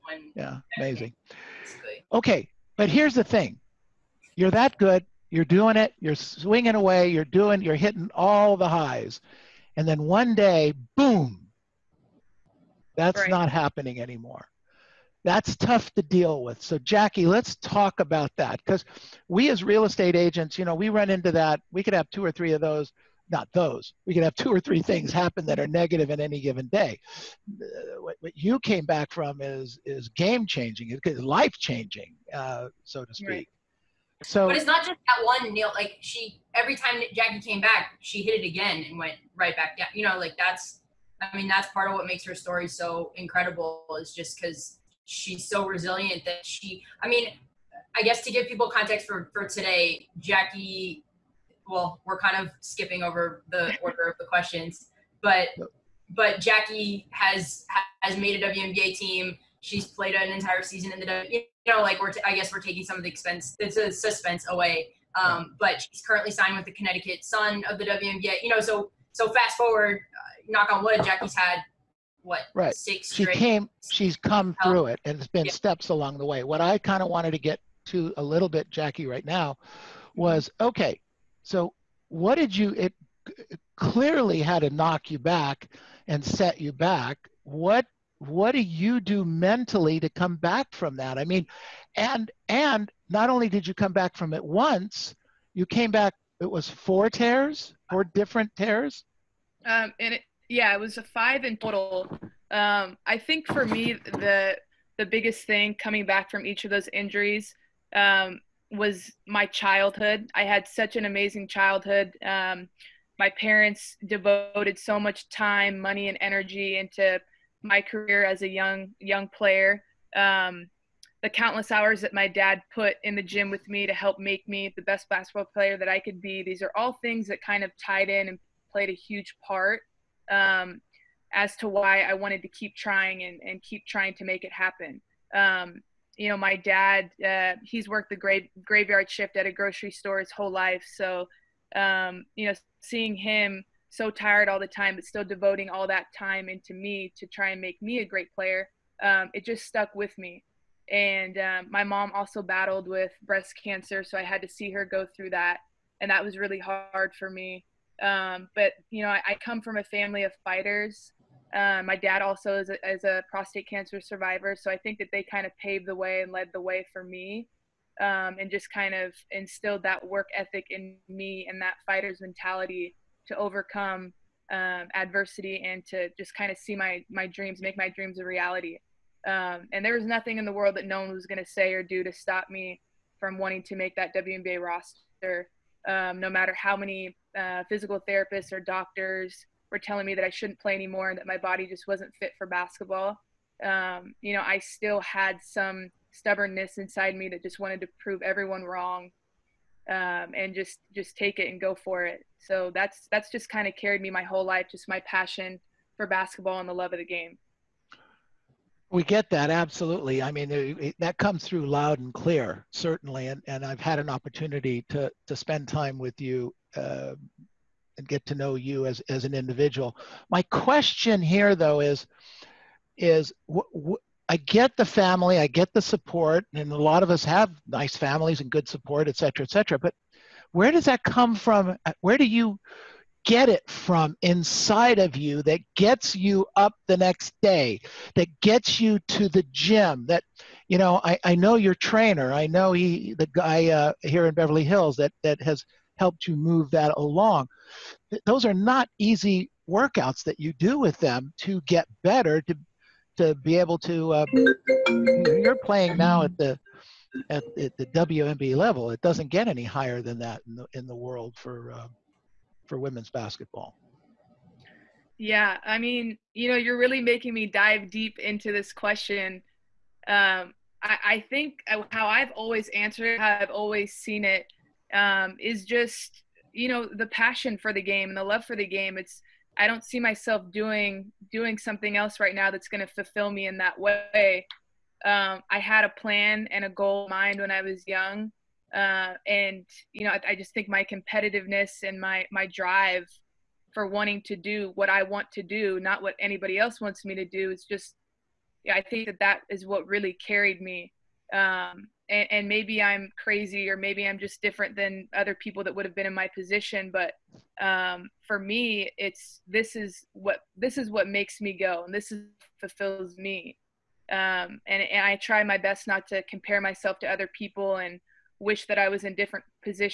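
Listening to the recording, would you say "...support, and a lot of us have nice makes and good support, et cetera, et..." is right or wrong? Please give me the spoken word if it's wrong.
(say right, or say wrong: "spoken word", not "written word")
wrong: "families", not "makes".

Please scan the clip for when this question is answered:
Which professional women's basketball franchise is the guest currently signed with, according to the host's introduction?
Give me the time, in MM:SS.
01:06.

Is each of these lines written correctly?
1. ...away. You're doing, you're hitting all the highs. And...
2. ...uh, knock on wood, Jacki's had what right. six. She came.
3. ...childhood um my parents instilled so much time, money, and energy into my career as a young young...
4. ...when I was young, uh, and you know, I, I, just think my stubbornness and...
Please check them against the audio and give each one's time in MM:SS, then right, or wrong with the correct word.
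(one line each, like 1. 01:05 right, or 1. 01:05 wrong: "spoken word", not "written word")
1. 00:06 right
2. 01:09 right
3. 01:51 wrong: "devoted", not "instilled"
4. 04:47 wrong: "competitiveness", not "stubbornness".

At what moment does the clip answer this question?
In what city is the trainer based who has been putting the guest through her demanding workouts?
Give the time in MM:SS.
04:04.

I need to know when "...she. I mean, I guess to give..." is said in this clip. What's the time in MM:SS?
00:46.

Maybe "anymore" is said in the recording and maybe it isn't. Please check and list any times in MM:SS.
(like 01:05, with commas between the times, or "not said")
00:14, 03:10.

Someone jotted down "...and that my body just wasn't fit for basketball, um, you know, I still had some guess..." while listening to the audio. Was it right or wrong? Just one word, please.
wrong.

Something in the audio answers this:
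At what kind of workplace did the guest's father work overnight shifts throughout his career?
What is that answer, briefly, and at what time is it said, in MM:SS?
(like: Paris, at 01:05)
A grocery store, at 02:19.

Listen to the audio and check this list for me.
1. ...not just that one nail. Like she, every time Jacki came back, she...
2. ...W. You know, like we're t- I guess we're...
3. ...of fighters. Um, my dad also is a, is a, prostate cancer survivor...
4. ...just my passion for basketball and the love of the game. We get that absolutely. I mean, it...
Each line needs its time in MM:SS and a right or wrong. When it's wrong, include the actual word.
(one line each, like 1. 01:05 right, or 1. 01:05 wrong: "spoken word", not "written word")
1. 00:34 right
2. 01:01 right
3. 02:40 right
4. 03:24 right.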